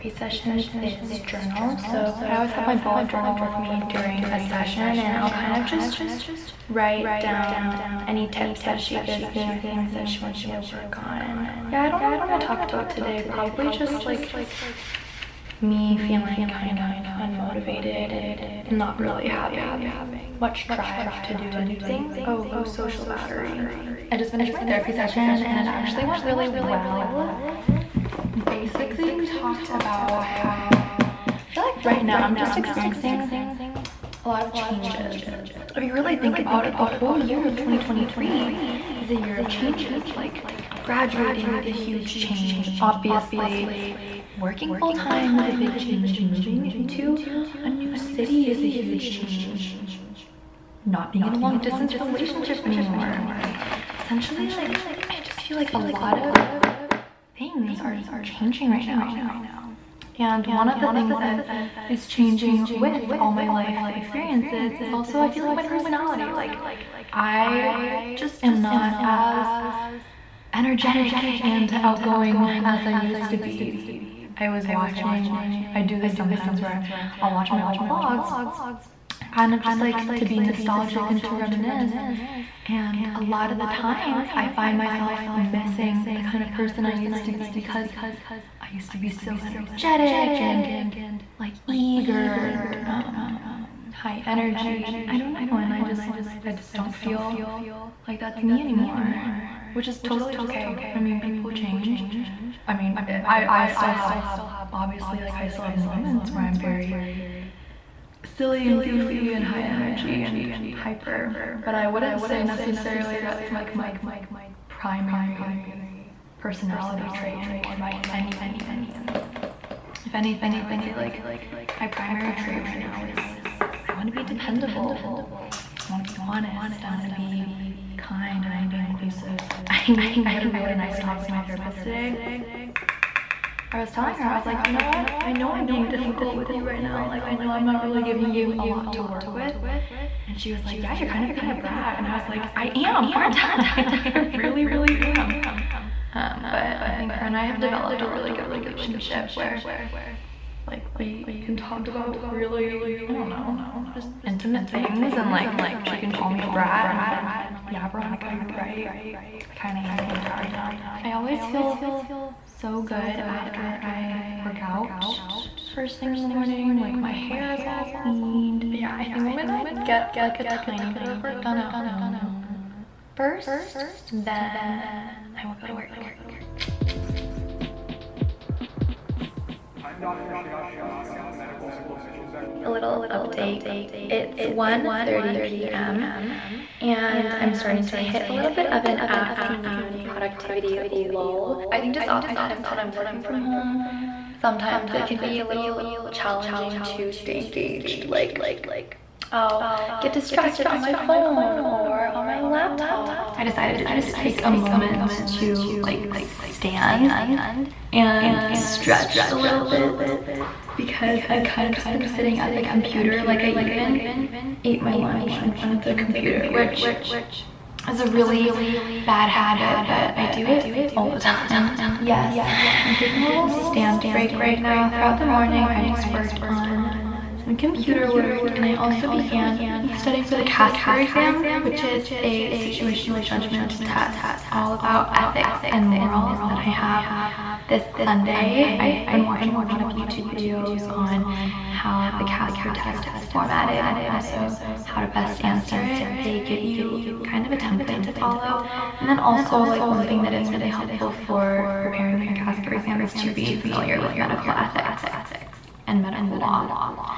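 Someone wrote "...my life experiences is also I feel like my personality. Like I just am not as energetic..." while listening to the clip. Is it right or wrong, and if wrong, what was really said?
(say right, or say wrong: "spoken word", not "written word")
right.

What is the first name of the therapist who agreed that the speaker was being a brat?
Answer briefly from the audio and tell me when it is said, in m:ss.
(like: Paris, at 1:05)
Veronica, at 2:37.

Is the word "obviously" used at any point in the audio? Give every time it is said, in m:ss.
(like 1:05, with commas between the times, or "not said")
0:42, 1:44.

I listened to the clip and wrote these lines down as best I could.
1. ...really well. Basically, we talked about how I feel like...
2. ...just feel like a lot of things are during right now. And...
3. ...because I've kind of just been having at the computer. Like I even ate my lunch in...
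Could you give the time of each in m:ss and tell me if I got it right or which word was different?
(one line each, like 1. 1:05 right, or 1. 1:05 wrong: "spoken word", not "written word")
1. 0:26 right
2. 0:55 wrong: "changing", not "during"
3. 3:30 wrong: "sitting", not "having".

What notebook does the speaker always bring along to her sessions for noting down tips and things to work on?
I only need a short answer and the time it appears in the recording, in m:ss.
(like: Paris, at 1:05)
bullet journal, at 0:02.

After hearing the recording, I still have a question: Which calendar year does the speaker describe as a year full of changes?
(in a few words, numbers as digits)
2023.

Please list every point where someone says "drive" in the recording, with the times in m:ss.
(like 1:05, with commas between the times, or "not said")
0:20.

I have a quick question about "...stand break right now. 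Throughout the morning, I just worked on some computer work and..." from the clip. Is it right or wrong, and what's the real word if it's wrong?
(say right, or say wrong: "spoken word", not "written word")
right.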